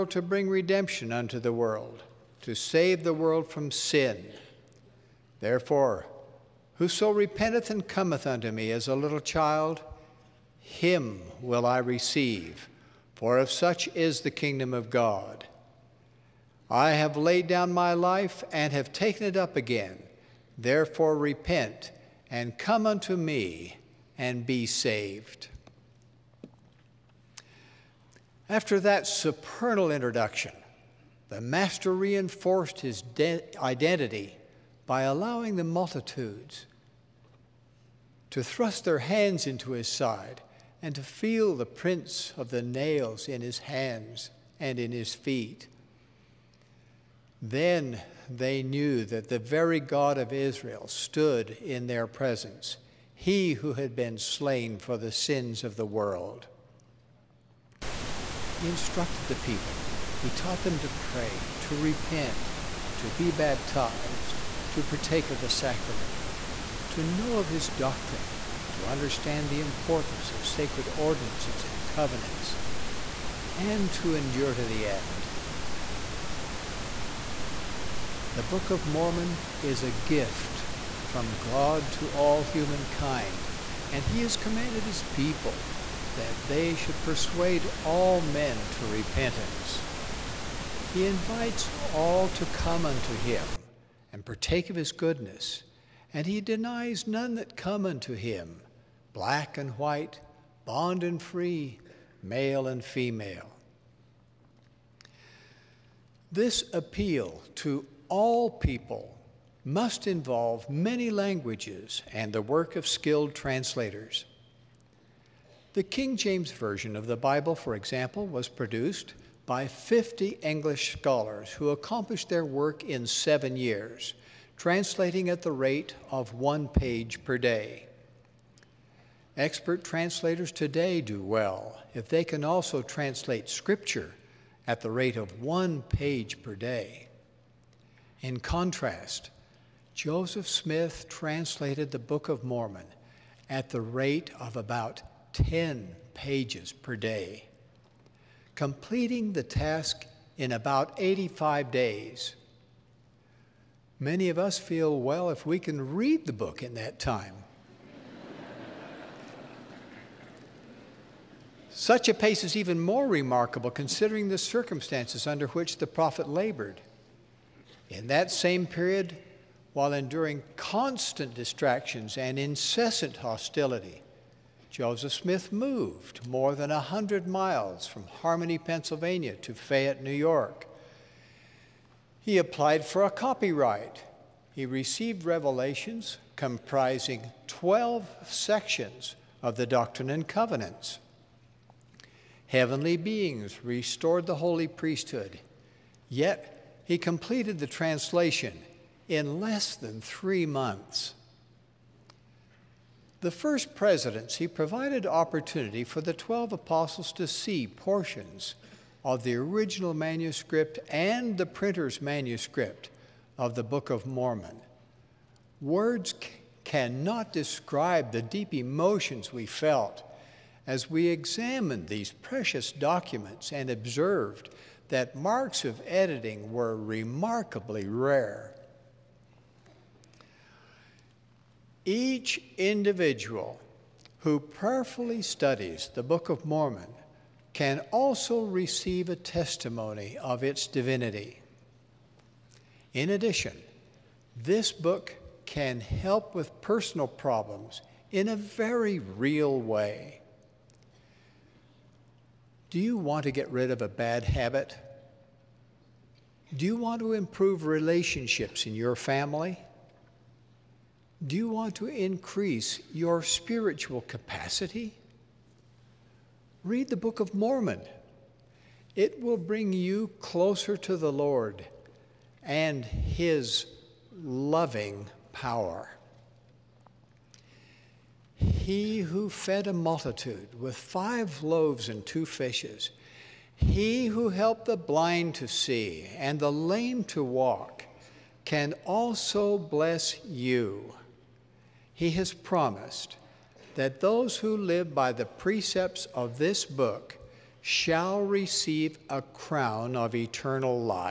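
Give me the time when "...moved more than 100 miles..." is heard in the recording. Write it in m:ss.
2:55.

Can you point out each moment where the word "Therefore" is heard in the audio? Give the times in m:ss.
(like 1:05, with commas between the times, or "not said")
0:05, 0:20.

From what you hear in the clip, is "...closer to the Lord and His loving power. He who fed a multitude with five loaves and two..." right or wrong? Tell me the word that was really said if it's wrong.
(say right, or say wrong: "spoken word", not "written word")
right.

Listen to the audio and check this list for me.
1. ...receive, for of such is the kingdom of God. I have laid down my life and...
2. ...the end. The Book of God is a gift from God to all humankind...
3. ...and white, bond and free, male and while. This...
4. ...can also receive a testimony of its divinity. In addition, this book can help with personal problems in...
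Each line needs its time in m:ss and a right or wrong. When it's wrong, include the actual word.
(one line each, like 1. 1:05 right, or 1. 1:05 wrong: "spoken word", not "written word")
1. 0:11 right
2. 1:14 wrong: "Mormon", not "God"
3. 1:39 wrong: "female", not "while"
4. 3:57 right.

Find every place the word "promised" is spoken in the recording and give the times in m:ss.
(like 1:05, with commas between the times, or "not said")
4:52.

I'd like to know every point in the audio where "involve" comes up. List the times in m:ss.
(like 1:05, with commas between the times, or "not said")
1:50.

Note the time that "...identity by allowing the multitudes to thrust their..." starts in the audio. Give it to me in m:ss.
0:33.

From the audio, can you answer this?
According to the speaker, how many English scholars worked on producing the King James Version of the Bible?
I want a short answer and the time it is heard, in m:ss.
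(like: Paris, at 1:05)
50, at 1:59.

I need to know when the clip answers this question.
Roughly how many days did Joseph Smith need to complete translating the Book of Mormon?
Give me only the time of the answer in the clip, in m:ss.
2:30.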